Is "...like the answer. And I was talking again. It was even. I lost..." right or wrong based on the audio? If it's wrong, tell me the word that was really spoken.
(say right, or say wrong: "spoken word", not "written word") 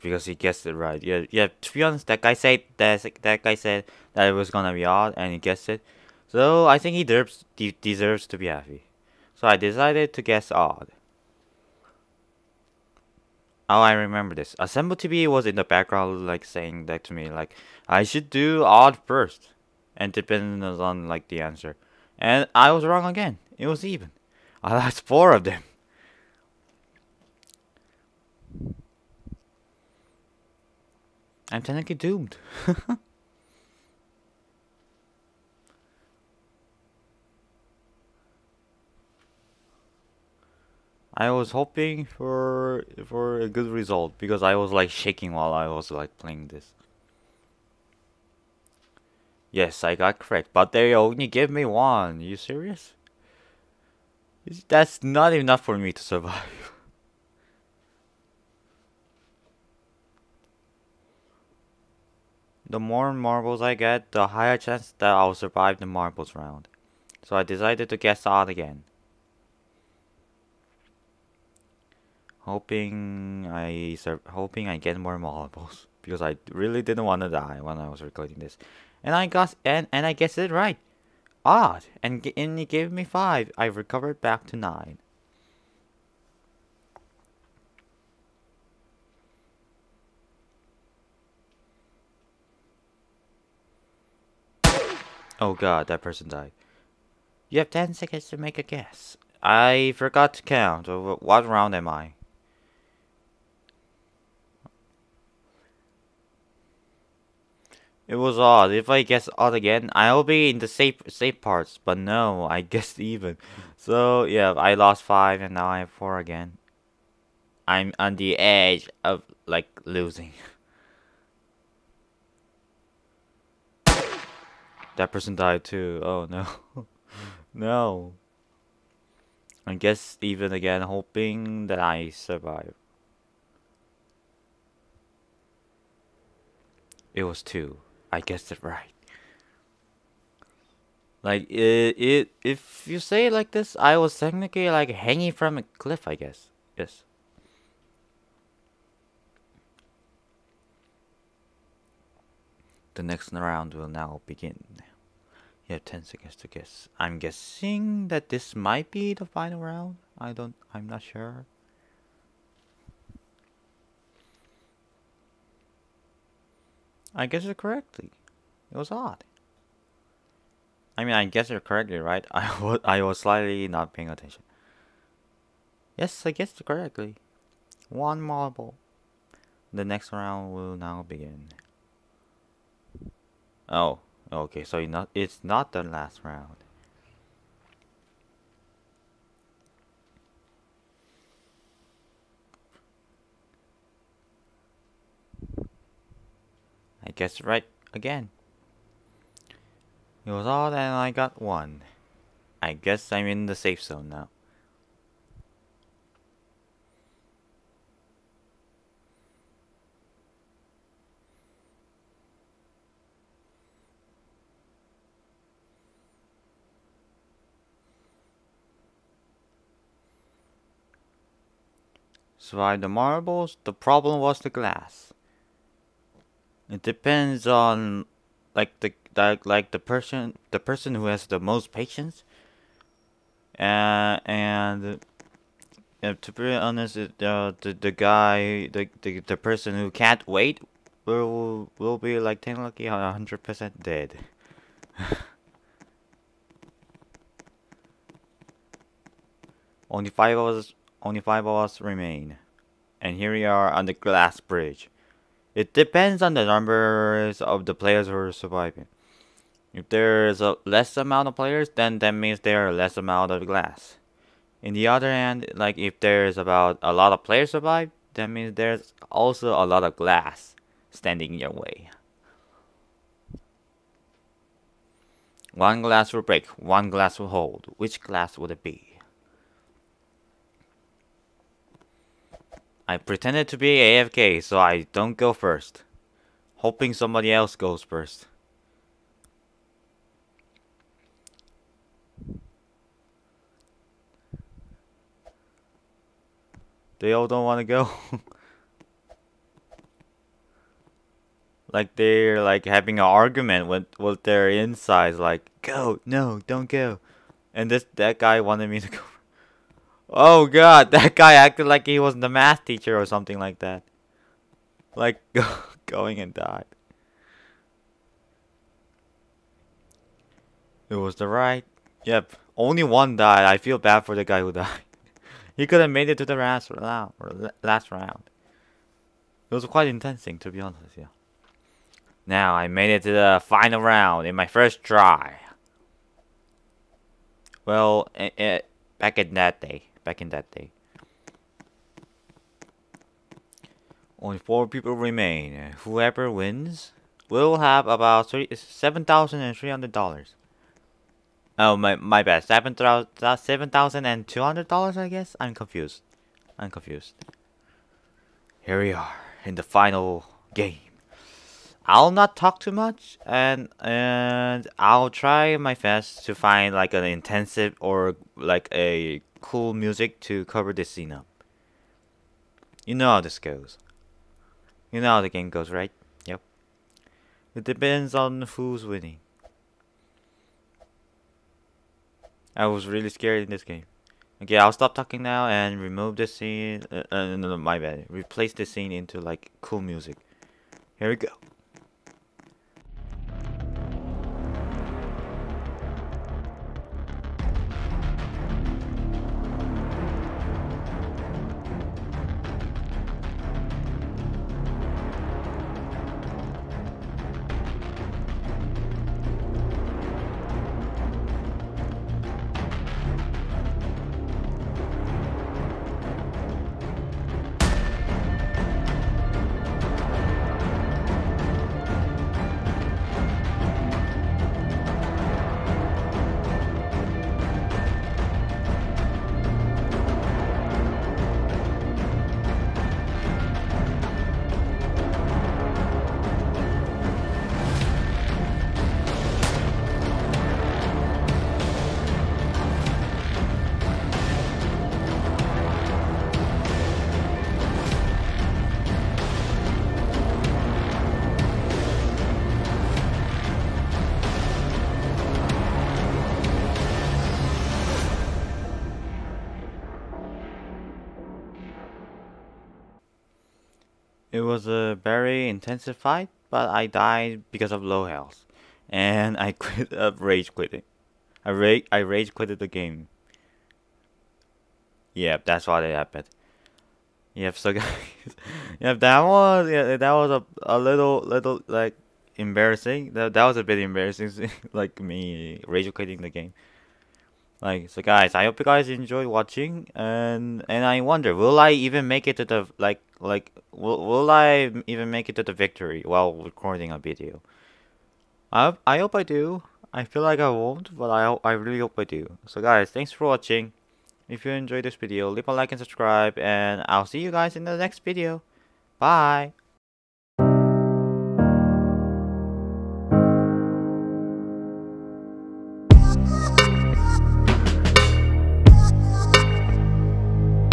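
wrong: "wrong", not "talking".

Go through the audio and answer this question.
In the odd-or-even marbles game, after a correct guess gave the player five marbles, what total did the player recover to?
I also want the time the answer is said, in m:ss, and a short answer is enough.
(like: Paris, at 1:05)
9, at 1:23.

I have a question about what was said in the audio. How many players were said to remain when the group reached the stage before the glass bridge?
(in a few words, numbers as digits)
5.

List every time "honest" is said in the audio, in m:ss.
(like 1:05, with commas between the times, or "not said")
0:01, 3:56, 5:30.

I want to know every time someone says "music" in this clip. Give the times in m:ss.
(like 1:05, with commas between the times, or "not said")
6:09, 6:29.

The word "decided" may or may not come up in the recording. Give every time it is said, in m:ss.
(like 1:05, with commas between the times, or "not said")
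0:09, 1:07.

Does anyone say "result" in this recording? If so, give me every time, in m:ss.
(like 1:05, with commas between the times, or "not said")
0:43.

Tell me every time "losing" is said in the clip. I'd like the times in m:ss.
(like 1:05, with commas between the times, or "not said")
1:59.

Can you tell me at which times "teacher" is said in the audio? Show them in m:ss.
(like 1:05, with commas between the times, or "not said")
5:12.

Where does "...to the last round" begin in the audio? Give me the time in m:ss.
5:26.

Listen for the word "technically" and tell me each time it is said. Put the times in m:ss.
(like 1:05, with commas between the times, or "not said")
0:31, 2:24.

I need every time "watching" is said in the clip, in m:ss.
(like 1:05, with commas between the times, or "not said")
8:09, 8:23.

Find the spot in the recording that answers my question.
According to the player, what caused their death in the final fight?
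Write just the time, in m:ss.
7:47.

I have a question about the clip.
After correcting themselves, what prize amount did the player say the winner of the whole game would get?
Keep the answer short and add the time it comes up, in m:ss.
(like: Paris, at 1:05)
$7,200, at 5:52.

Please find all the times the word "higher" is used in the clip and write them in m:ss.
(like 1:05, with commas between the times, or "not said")
1:04.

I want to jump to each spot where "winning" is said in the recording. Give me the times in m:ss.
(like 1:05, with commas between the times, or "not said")
6:18.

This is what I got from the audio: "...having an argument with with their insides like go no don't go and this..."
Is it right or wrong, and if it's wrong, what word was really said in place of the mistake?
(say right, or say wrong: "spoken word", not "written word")
right.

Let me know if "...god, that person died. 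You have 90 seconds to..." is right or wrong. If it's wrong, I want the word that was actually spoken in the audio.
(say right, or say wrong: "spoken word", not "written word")
wrong: "10", not "90".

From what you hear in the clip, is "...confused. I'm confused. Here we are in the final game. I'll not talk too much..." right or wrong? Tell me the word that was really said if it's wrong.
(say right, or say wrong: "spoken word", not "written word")
right.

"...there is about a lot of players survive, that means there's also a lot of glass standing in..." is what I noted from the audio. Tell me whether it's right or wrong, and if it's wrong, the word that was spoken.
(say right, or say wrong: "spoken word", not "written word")
right.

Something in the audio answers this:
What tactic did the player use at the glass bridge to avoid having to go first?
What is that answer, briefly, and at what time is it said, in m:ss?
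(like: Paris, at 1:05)
Pretended to be AFK, at 4:42.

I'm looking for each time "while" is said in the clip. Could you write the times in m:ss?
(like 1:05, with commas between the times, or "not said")
0:45, 8:16.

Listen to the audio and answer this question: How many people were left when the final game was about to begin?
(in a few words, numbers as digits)
4.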